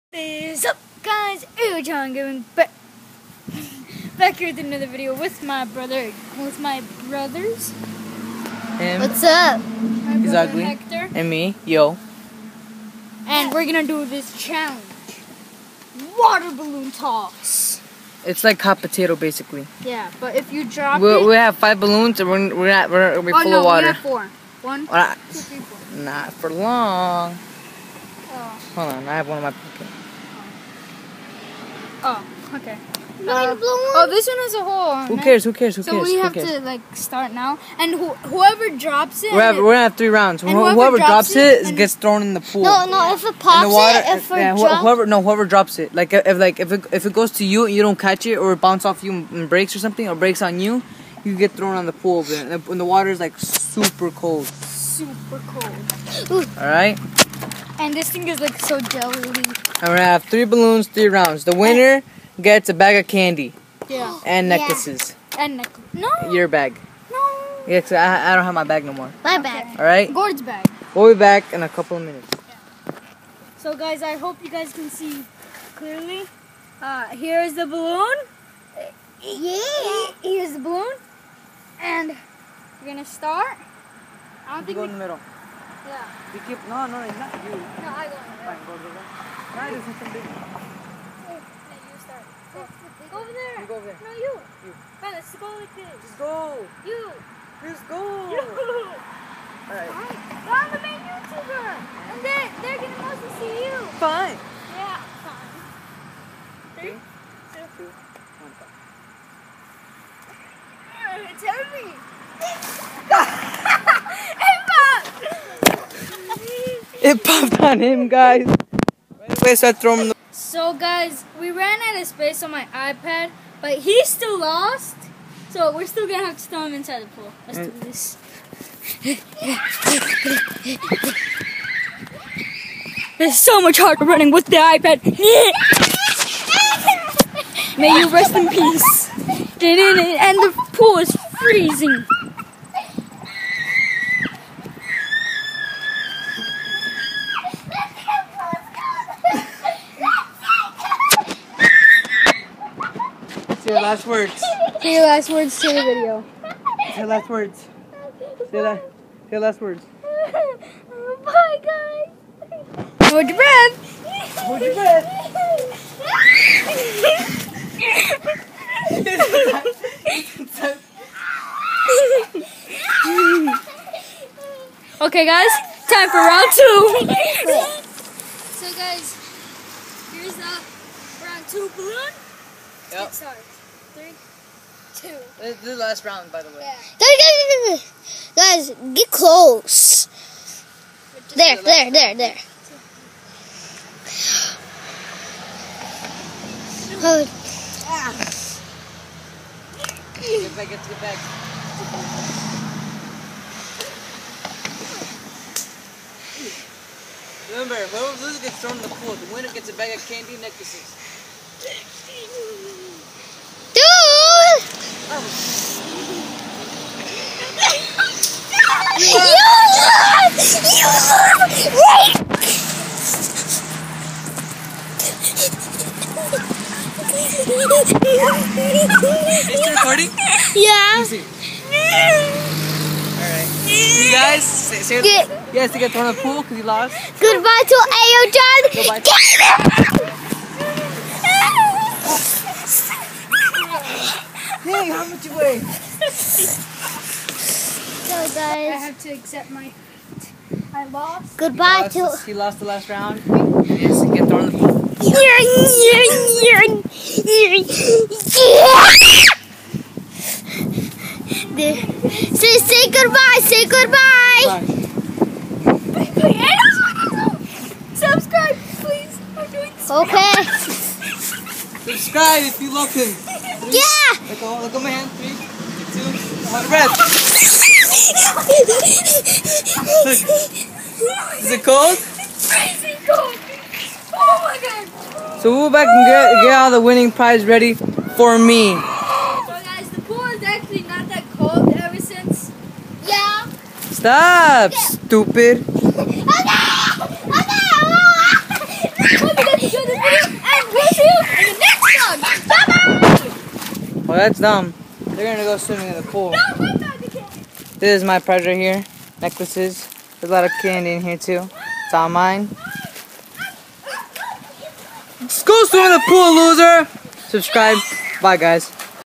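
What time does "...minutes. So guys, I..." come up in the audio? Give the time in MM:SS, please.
01:12.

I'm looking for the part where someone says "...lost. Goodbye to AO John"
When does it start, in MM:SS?
03:56.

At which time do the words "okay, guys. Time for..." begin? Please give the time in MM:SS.
02:54.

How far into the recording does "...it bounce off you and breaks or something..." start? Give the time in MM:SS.
00:48.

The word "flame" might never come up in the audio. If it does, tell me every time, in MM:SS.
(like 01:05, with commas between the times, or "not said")
not said.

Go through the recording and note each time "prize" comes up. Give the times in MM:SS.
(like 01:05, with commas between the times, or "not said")
04:47, 05:08.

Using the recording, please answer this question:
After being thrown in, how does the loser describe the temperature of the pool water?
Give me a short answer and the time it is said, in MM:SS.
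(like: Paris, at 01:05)
Crazy cold, at 04:42.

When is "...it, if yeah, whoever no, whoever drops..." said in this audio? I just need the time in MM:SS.
00:43.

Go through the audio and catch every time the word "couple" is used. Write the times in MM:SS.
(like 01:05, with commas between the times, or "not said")
01:11.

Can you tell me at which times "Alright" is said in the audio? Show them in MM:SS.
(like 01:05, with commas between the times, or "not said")
01:38, 03:53.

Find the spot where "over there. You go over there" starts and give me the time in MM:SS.
01:33.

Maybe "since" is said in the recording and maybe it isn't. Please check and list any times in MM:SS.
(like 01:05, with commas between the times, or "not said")
04:51.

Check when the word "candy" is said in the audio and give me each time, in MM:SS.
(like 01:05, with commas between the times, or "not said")
01:03, 03:30, 05:10.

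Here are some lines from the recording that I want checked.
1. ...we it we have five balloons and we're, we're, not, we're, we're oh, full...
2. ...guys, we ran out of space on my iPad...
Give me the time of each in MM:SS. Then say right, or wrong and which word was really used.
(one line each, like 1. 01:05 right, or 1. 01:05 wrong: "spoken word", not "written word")
1. 00:20 right
2. 02:00 right.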